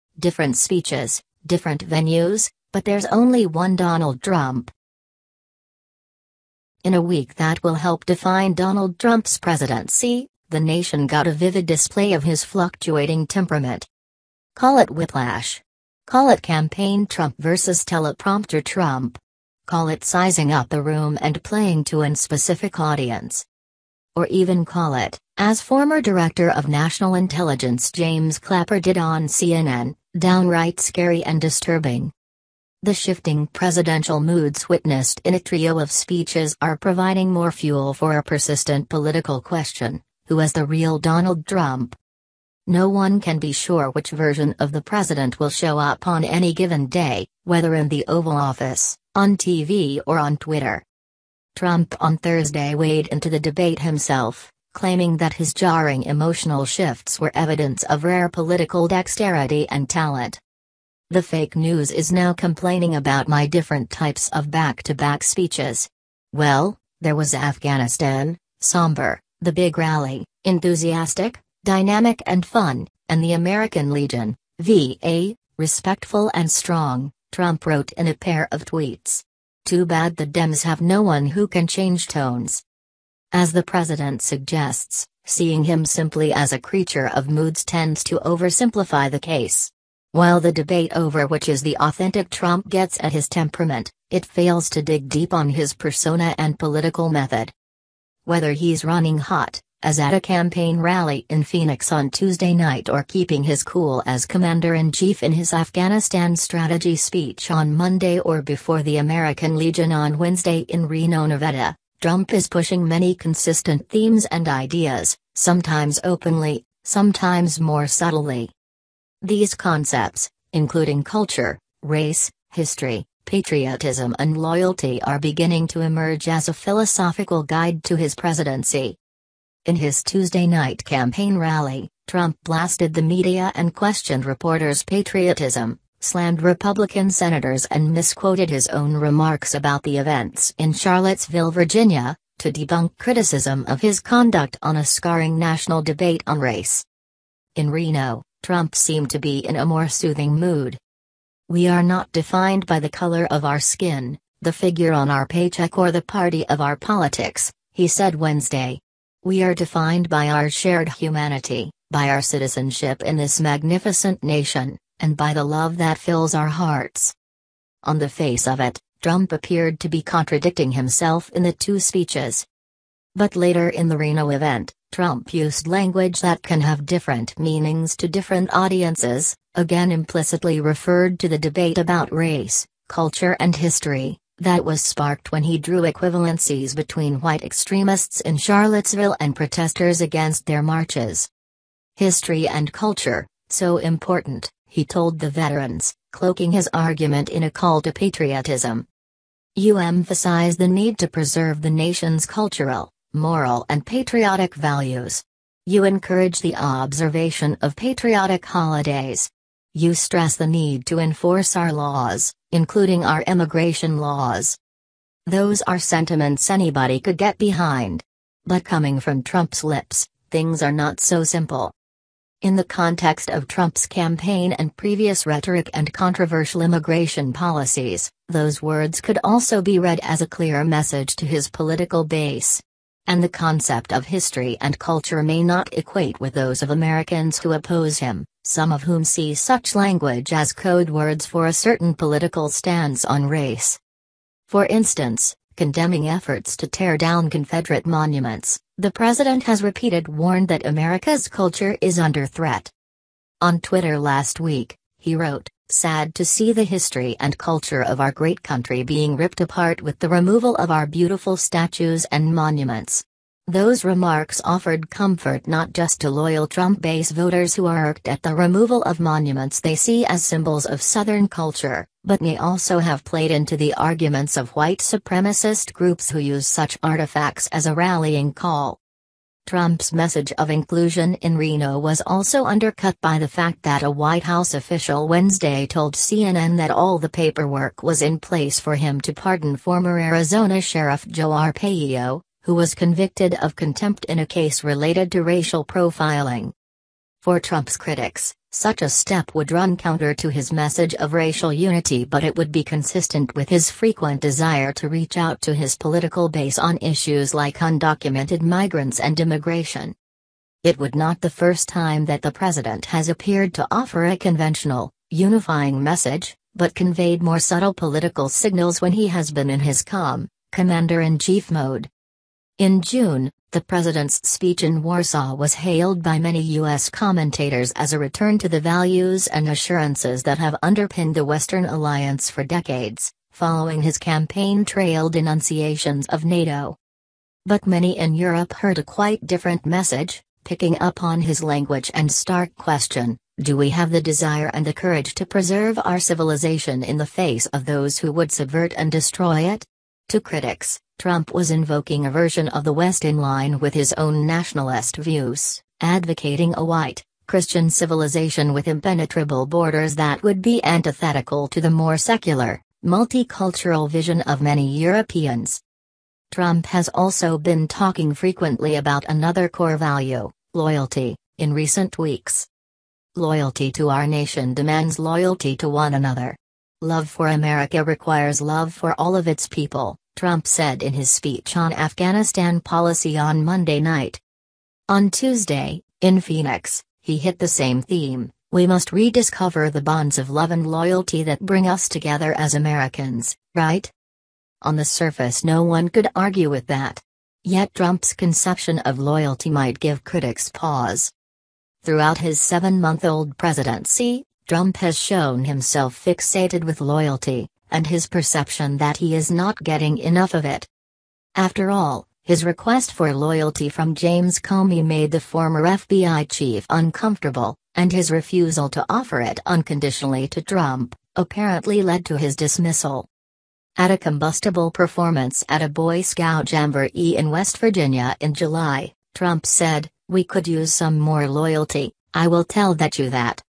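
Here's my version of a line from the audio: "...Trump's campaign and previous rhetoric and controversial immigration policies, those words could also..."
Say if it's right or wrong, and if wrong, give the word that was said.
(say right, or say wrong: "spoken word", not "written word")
right.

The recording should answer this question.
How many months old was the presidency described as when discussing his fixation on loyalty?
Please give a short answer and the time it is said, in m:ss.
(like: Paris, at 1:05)
7, at 6:42.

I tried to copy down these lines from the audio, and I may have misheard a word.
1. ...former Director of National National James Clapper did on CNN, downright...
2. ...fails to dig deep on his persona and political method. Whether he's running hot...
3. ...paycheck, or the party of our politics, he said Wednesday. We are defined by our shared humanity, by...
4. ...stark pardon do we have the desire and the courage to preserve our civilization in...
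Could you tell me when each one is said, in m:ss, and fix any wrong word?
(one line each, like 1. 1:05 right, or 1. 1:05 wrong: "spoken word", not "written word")
1. 0:25 wrong: "Intelligence", not "National"
2. 1:34 right
3. 2:35 right
4. 5:42 wrong: "question", not "pardon".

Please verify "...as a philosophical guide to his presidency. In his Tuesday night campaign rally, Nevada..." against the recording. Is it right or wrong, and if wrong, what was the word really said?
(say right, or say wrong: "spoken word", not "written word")
wrong: "Trump", not "Nevada".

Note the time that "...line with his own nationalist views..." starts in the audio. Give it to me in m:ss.
5:53.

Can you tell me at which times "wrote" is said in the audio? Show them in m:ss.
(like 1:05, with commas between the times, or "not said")
1:17, 4:15.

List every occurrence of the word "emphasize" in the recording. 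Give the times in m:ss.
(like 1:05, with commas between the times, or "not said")
3:19.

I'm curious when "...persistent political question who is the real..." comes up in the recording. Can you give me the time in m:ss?
0:38.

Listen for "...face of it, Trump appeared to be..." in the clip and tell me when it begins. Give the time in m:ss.
2:48.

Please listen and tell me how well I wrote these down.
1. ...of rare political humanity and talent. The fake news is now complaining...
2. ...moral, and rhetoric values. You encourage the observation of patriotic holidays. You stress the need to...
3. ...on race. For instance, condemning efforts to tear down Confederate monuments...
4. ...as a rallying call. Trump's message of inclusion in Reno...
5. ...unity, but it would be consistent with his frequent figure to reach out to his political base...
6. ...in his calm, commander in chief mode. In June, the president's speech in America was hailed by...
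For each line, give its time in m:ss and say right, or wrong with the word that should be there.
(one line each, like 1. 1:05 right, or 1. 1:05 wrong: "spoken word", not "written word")
1. 0:57 wrong: "dexterity", not "humanity"
2. 3:23 wrong: "patriotic", not "rhetoric"
3. 4:03 right
4. 4:37 right
5. 5:01 wrong: "desire", not "figure"
6. 5:19 wrong: "Warsaw", not "America".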